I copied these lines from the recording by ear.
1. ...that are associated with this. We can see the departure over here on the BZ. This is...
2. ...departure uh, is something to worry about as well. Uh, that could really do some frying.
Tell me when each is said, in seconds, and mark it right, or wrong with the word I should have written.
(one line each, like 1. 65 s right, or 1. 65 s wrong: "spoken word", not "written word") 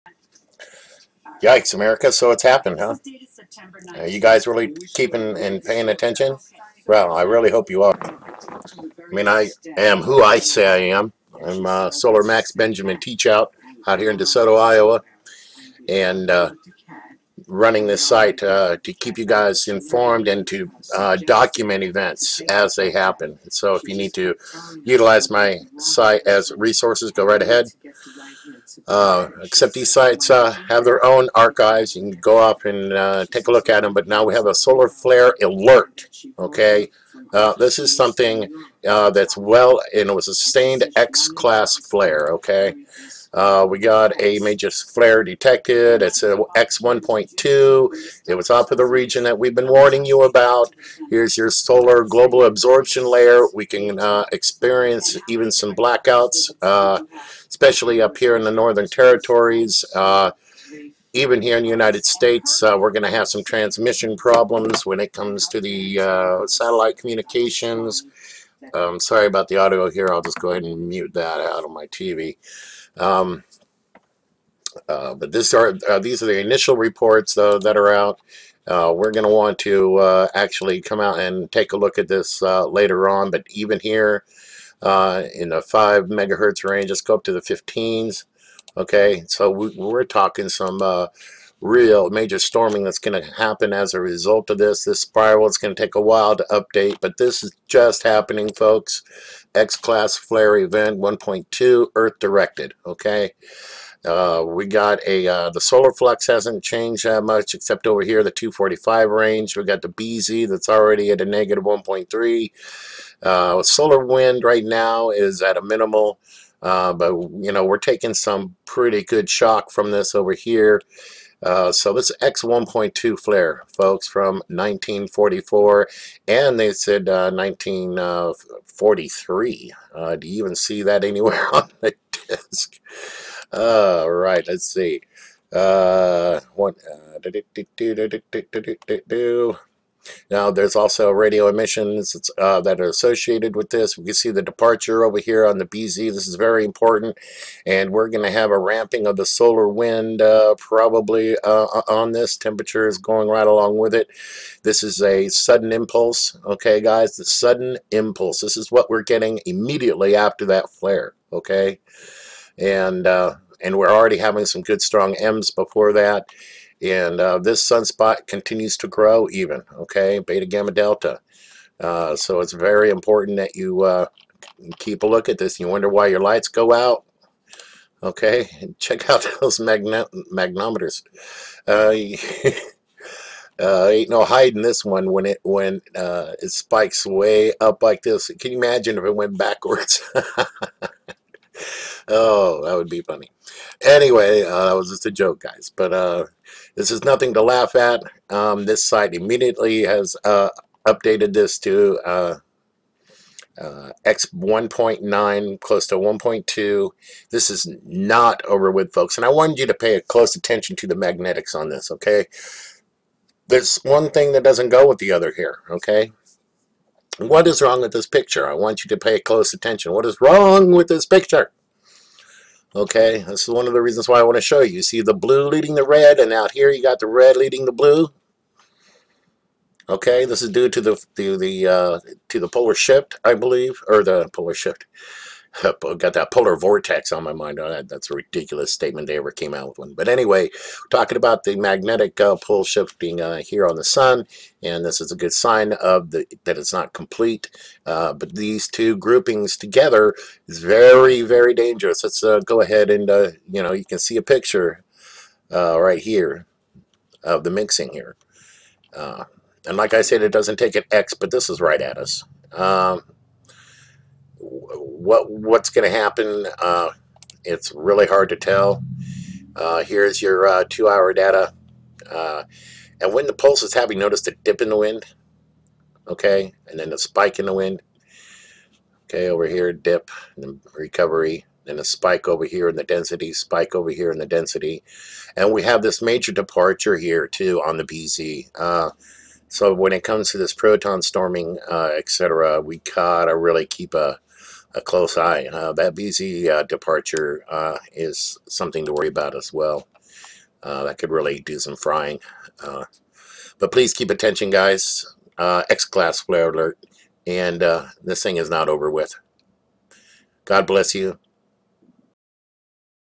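1. 142 s right
2. 296 s right.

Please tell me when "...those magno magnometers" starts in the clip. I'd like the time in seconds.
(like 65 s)
179 s.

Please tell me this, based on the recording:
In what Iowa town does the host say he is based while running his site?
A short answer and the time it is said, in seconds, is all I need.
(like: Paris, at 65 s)
DeSoto, at 14 s.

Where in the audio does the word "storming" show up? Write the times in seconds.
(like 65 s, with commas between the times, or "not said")
92 s, 291 s.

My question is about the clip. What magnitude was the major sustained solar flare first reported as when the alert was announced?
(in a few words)
X1.2.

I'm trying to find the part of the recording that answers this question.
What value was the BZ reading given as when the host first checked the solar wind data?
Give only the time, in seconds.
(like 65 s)
111 s.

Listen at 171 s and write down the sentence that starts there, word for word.
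Uh, so it's very important that you uh, keep a look at this.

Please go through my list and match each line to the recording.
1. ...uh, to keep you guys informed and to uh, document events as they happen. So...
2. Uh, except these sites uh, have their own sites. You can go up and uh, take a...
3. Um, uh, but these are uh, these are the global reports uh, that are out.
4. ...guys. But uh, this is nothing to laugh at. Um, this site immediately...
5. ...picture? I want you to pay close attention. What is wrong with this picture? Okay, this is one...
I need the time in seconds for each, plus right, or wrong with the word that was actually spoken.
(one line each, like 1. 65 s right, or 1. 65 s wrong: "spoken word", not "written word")
1. 18 s right
2. 28 s wrong: "archives", not "sites"
3. 72 s wrong: "initial", not "global"
4. 195 s right
5. 218 s right.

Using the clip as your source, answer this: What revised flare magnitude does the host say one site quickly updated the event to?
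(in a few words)
X1.9.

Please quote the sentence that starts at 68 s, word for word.
Um, sorry about the audio here.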